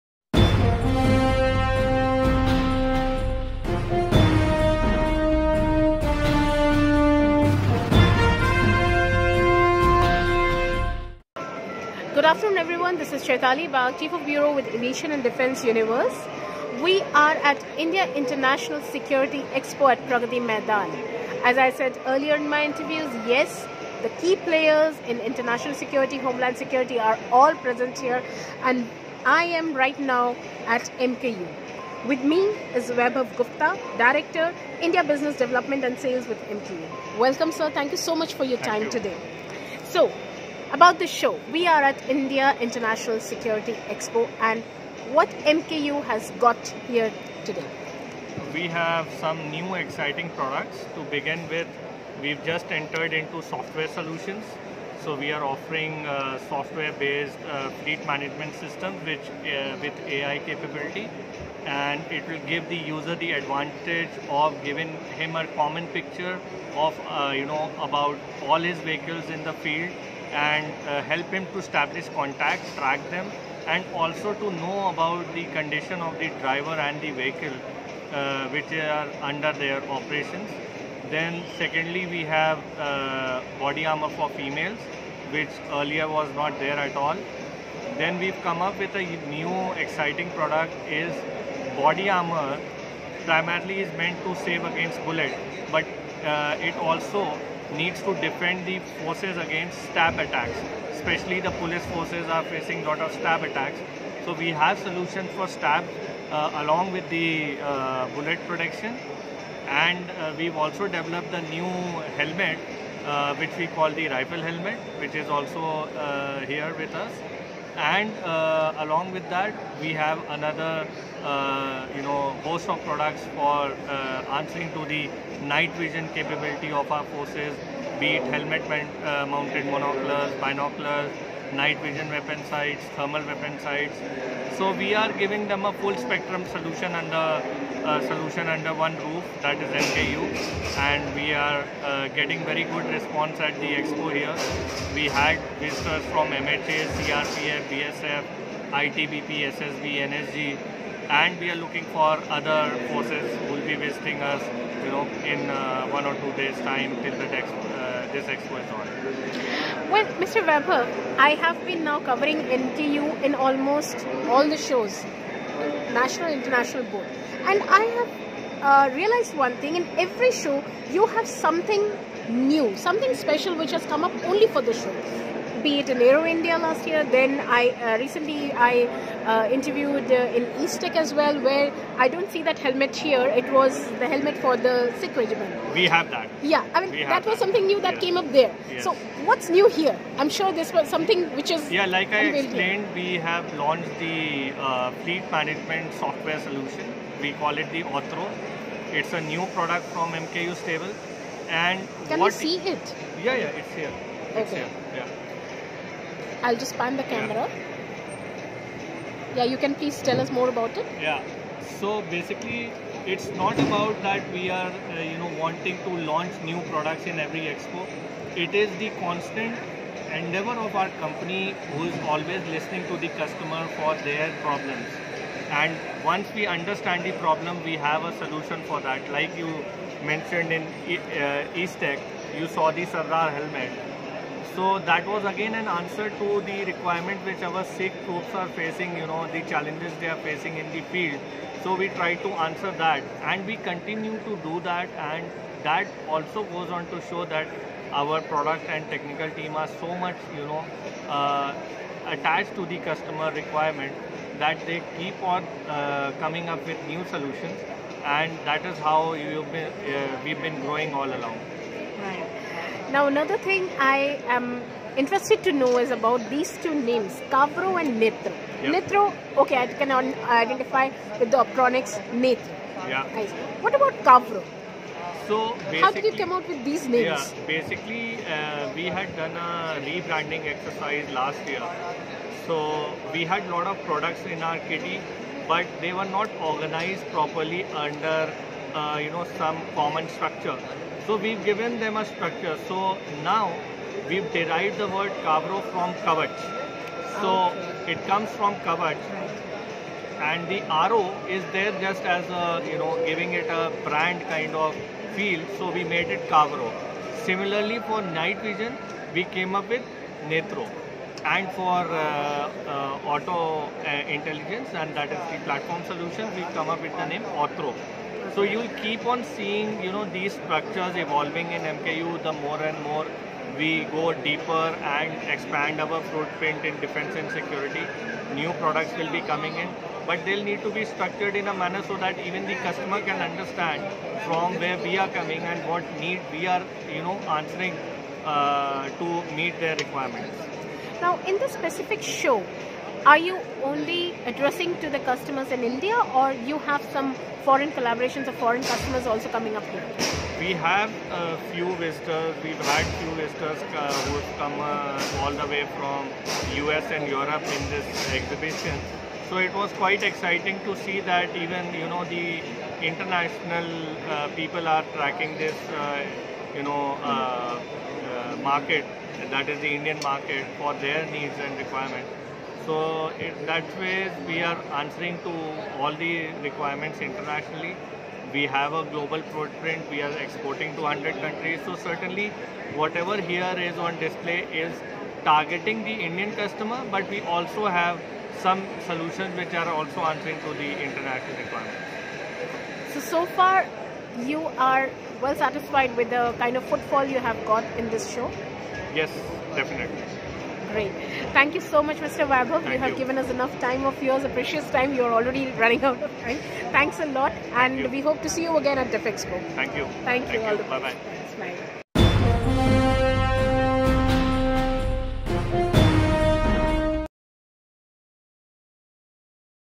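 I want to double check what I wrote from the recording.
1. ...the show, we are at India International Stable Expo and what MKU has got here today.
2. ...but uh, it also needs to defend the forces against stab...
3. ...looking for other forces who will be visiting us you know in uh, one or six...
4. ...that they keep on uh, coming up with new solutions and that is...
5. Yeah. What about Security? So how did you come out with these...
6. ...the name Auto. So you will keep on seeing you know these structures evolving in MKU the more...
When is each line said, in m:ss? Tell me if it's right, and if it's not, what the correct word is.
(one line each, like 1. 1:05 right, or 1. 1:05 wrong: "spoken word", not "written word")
1. 0:40 wrong: "Security", not "Stable"
2. 1:35 right
3. 2:31 wrong: "two", not "six"
4. 4:14 right
5. 4:32 wrong: "Kavro", not "Security"
6. 5:16 right.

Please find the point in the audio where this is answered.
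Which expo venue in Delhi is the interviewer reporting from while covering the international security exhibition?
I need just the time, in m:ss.
0:20.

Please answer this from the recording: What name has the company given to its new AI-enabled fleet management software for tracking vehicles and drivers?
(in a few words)
Orthro.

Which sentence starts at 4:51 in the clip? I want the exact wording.
So we've given them a structure.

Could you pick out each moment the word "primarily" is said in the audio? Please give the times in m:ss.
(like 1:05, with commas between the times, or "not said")
1:33.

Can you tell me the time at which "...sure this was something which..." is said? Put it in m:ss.
3:10.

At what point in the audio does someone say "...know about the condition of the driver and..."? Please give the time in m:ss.
1:14.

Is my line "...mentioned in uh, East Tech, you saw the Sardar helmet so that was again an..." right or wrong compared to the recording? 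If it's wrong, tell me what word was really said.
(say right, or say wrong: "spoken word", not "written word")
right.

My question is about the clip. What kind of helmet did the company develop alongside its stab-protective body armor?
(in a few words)
rifle helmet.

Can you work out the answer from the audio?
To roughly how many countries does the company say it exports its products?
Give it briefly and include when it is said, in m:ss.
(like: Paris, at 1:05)
100, at 6:20.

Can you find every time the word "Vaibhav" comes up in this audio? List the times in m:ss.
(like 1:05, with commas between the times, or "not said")
0:32, 2:40, 6:42.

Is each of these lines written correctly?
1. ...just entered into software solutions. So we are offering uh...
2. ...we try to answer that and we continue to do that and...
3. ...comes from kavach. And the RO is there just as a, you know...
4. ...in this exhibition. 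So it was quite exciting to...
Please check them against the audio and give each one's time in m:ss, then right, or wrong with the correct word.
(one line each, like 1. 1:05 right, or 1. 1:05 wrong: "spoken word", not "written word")
1. 0:52 right
2. 4:01 right
3. 4:58 right
4. 5:57 right.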